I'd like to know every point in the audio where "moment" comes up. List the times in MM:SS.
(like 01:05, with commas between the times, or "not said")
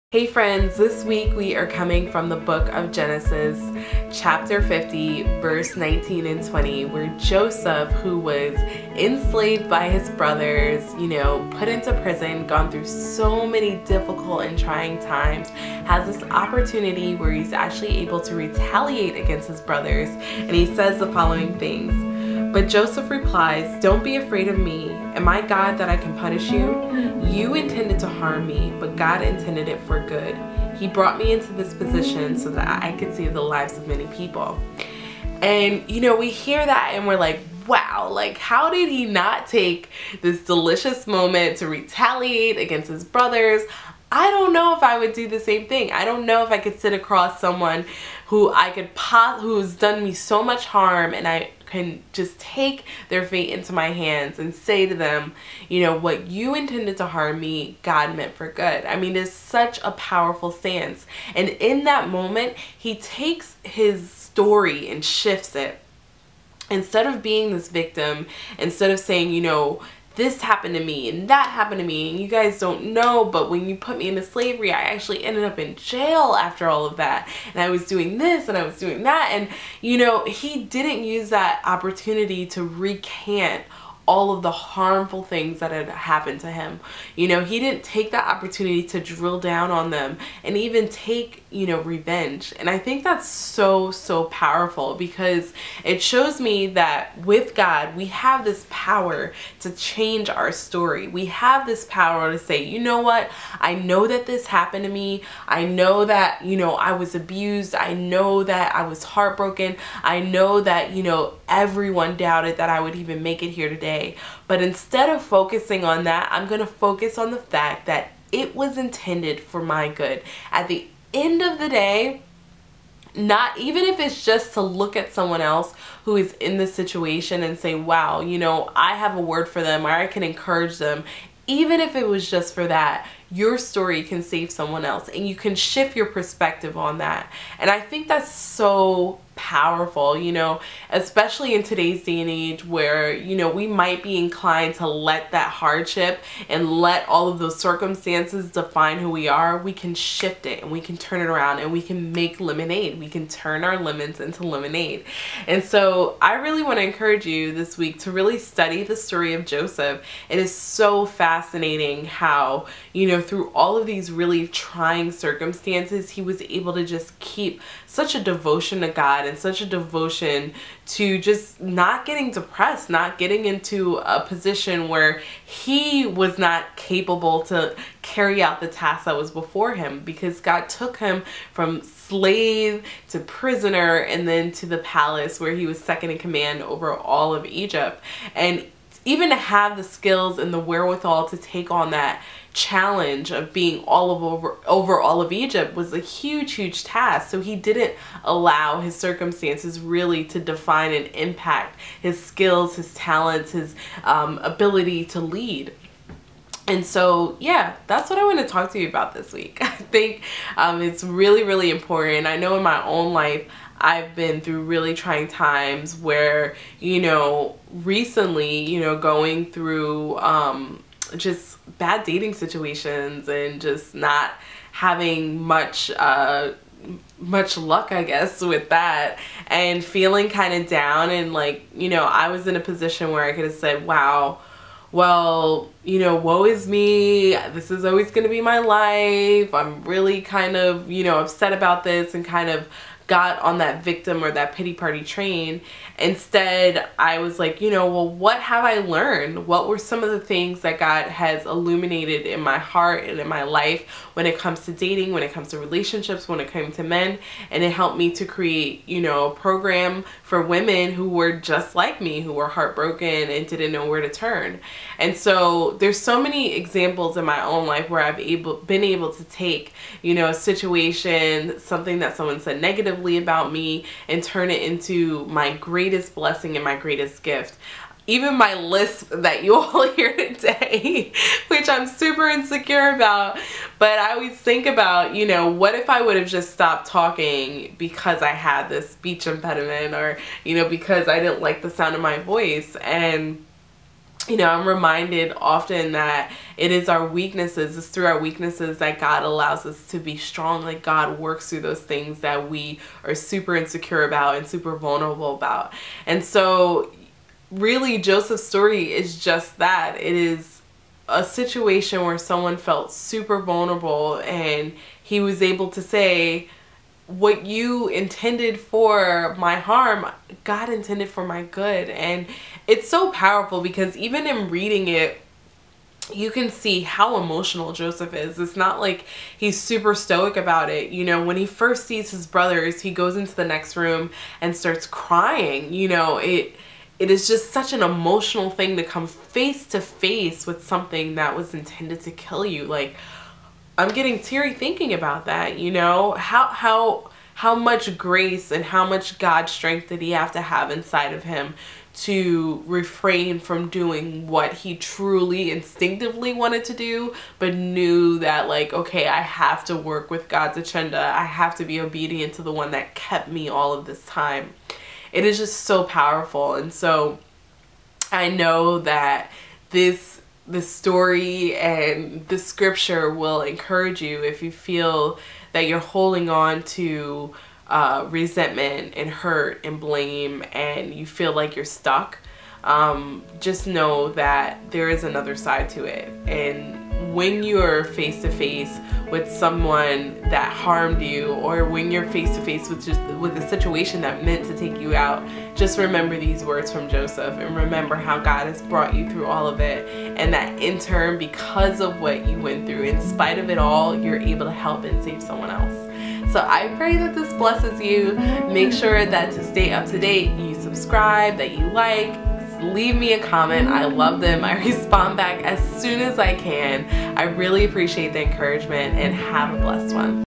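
00:41, 01:02.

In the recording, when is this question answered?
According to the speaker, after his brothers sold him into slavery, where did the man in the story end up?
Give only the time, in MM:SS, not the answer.
01:15.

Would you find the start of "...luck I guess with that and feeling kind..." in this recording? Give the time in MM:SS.
03:47.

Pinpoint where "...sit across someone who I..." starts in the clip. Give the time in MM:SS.
00:46.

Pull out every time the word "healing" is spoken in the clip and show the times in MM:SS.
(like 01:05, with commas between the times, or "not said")
not said.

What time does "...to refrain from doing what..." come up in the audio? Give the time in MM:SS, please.
05:51.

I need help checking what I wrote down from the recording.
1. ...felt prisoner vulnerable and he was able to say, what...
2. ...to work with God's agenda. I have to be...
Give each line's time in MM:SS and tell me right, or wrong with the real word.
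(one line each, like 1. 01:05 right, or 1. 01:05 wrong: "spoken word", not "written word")
1. 05:12 wrong: "super", not "prisoner"
2. 05:59 right.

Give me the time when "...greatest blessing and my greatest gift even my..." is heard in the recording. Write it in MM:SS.
04:35.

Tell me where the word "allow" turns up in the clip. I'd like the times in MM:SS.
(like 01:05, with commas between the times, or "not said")
03:18, 04:59.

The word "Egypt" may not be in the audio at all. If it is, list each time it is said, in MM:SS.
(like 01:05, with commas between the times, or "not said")
03:07, 03:15.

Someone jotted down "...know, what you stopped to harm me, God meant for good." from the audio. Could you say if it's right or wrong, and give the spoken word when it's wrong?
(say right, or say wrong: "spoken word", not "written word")
wrong: "intended", not "stopped".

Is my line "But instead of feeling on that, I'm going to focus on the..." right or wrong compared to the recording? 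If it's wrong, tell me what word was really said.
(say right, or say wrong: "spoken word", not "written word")
wrong: "focusing", not "feeling".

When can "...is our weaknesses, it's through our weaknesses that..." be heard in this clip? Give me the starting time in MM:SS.
04:56.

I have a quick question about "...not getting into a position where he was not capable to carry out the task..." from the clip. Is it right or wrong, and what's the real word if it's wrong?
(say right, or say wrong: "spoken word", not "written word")
right.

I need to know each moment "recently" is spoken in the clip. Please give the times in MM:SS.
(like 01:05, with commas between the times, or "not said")
03:37.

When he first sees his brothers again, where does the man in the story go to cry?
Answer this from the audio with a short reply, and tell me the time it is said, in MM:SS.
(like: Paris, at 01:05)
The next room, at 05:33.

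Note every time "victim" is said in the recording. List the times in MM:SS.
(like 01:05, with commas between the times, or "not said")
01:07, 04:03.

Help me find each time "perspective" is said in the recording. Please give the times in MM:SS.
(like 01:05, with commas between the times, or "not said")
02:16.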